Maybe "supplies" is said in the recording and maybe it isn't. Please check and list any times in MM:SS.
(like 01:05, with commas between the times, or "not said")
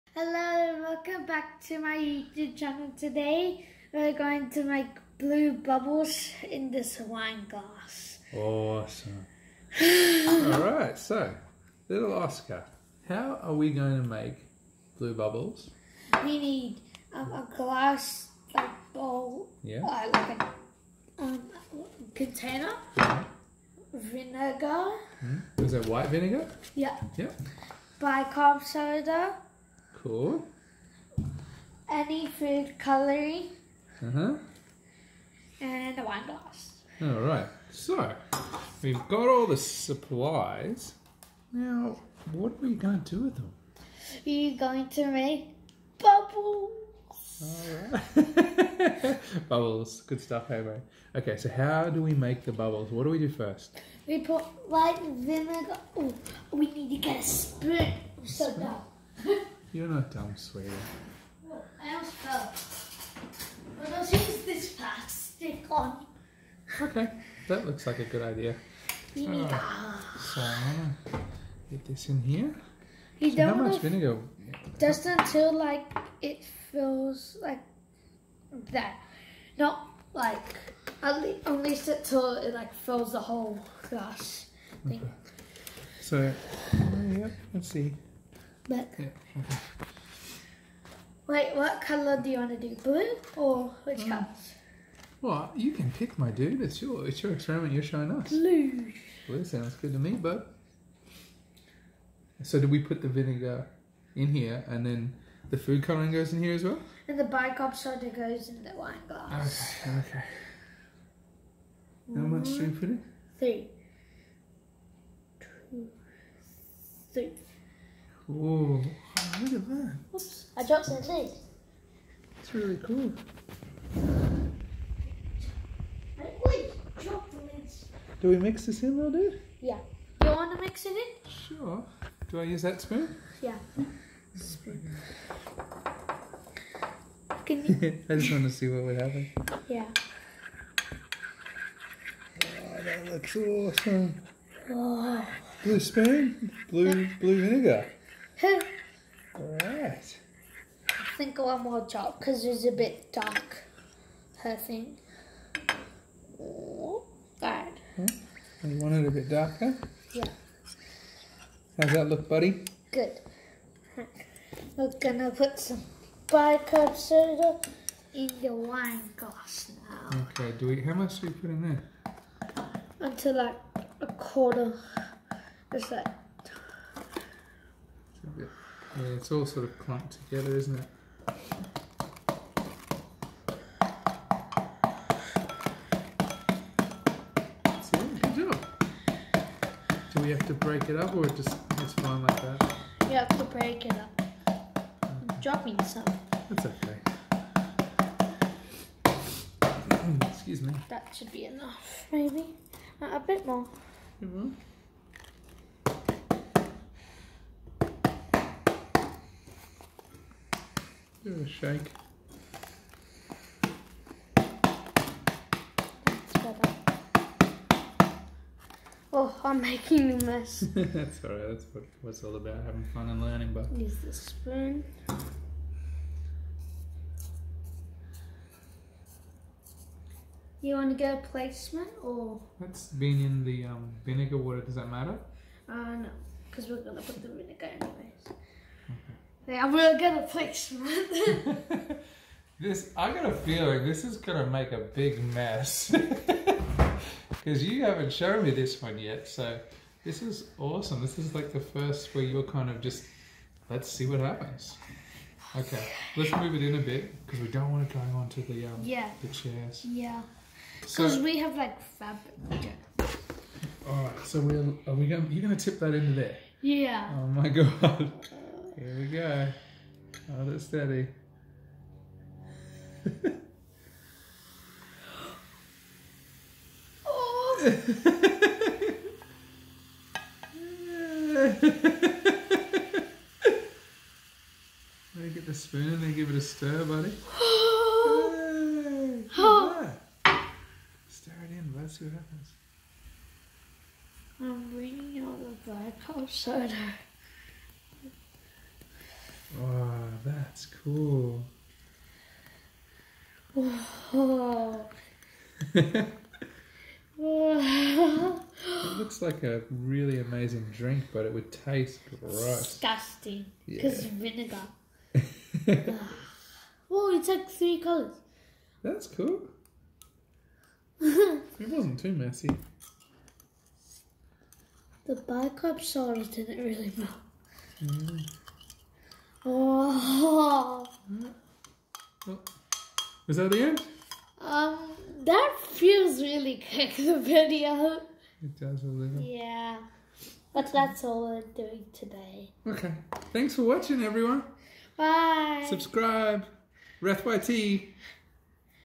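00:39.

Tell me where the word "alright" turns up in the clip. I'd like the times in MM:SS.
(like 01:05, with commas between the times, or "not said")
00:10, 00:47, 03:41.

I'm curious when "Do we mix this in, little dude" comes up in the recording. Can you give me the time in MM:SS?
02:08.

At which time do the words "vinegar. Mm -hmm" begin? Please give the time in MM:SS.
00:23.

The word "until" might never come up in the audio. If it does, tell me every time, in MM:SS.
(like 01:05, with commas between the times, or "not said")
01:15, 01:21, 02:53.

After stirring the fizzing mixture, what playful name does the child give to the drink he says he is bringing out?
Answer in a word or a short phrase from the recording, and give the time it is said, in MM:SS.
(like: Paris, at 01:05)
Black hole soda, at 04:55.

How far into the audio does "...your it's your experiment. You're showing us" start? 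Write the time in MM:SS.
01:36.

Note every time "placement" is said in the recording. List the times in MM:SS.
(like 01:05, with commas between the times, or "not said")
03:51, 04:00.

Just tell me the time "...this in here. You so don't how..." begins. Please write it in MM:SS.
01:11.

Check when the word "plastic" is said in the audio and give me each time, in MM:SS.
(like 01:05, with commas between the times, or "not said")
01:04.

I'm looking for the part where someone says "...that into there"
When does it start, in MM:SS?
04:25.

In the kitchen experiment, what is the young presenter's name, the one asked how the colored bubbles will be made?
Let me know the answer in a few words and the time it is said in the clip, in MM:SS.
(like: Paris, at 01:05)
Oscar, at 00:12.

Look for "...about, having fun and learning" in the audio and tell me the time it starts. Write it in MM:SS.
03:42.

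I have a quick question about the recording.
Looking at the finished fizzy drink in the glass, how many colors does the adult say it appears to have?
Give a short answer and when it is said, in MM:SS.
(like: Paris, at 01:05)
3, at 05:17.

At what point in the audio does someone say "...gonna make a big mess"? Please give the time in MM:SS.
04:04.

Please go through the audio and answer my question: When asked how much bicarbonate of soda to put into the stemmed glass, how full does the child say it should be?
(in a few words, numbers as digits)
A quarter.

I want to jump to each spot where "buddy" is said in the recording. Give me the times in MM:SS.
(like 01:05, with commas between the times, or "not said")
02:42, 04:46.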